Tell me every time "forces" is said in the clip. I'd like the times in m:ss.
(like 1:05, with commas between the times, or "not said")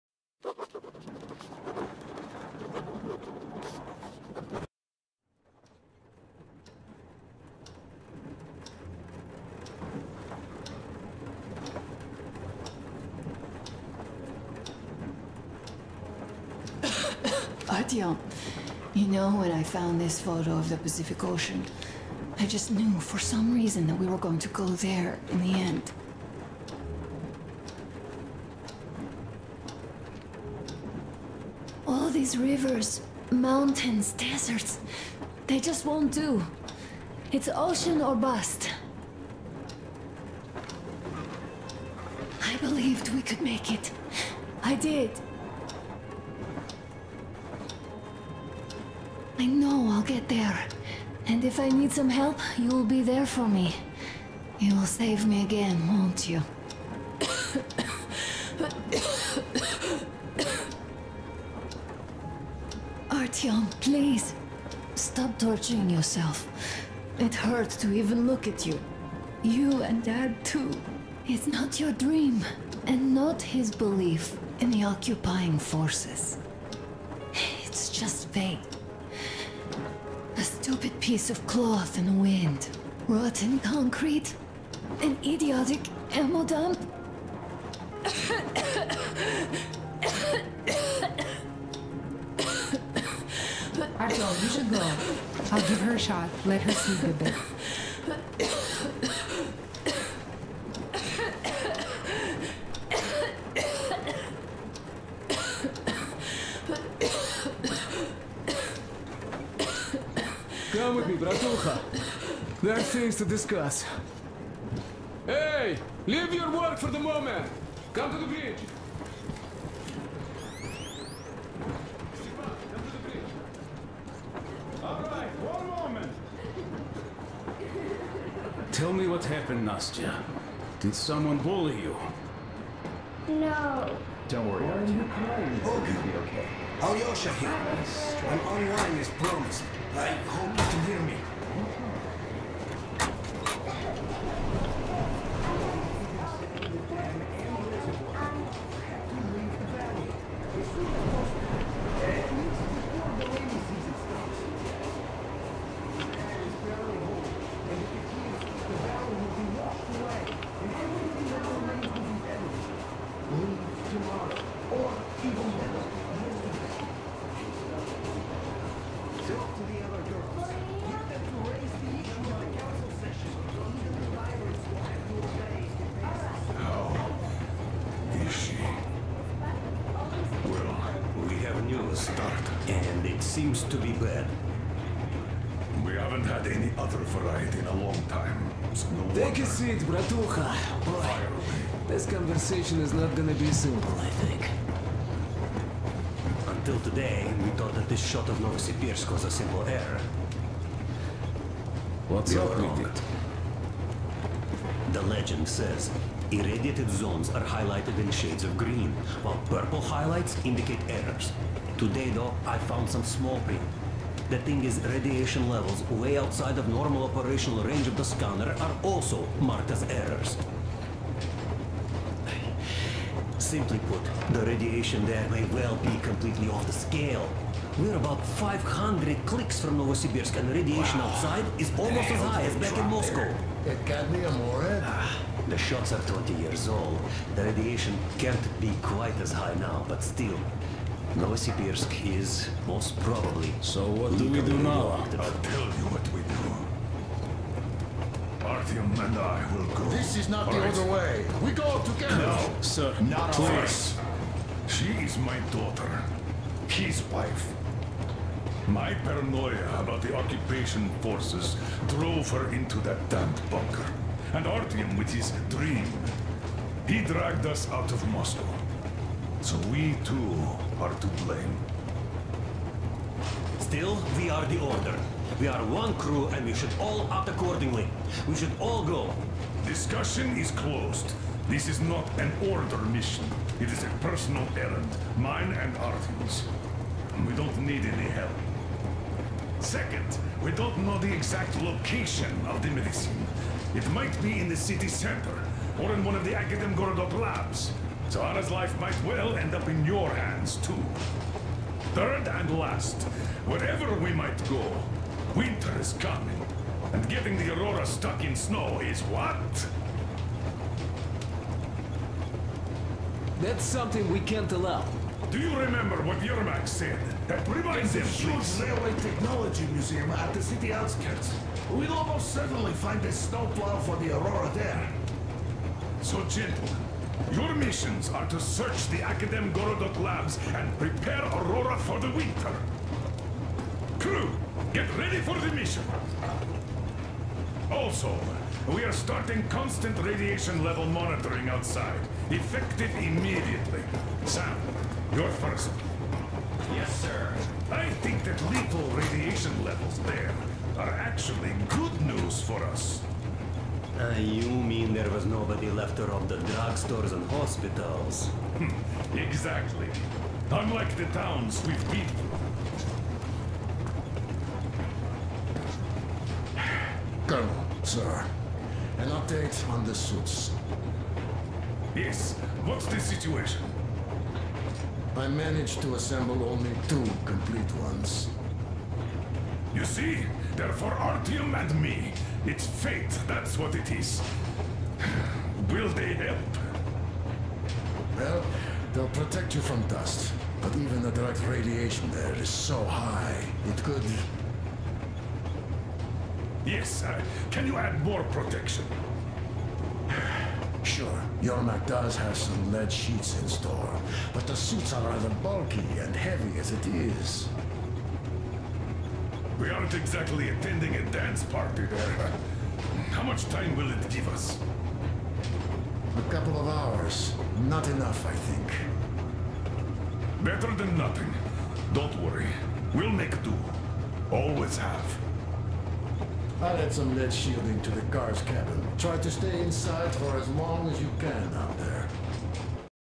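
1:15, 4:21.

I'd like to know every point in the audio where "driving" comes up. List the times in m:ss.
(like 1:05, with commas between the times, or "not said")
not said.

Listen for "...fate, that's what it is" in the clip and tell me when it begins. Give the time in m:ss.
6:22.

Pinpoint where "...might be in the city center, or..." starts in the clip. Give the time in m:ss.
4:53.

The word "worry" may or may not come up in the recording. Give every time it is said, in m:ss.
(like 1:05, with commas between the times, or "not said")
2:14, 7:02.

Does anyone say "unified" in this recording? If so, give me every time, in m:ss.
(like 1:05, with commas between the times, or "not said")
not said.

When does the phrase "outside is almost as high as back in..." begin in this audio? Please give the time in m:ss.
3:51.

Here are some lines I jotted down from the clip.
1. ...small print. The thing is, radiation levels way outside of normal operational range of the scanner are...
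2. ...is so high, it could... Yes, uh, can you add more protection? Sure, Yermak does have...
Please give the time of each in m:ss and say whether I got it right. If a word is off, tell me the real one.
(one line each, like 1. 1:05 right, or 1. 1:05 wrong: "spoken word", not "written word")
1. 3:33 right
2. 6:32 right.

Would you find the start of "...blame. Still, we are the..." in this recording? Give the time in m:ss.
4:31.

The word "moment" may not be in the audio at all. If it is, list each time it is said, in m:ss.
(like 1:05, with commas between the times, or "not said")
1:56, 2:05.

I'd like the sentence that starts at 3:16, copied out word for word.
Until today, we thought that this shot of Novosibirsk was a simple error.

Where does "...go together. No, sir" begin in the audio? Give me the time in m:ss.
4:11.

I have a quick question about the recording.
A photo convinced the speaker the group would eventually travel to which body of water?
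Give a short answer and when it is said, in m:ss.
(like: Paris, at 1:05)
Pacific Ocean, at 0:20.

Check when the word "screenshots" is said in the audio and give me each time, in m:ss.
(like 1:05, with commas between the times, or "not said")
not said.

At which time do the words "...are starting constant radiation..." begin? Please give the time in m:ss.
5:38.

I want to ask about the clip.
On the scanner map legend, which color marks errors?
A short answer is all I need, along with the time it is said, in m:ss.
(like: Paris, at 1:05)
Purple, at 3:29.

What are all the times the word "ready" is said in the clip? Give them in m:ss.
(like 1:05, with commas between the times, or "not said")
5:34.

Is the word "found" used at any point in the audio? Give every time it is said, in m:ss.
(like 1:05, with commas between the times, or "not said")
0:19, 3:32.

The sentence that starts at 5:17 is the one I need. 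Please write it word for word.
That reminds him, huge railway technology museum at the city outskirts.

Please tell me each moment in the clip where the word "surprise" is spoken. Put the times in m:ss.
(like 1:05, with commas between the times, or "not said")
not said.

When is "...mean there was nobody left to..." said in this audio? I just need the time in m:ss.
5:54.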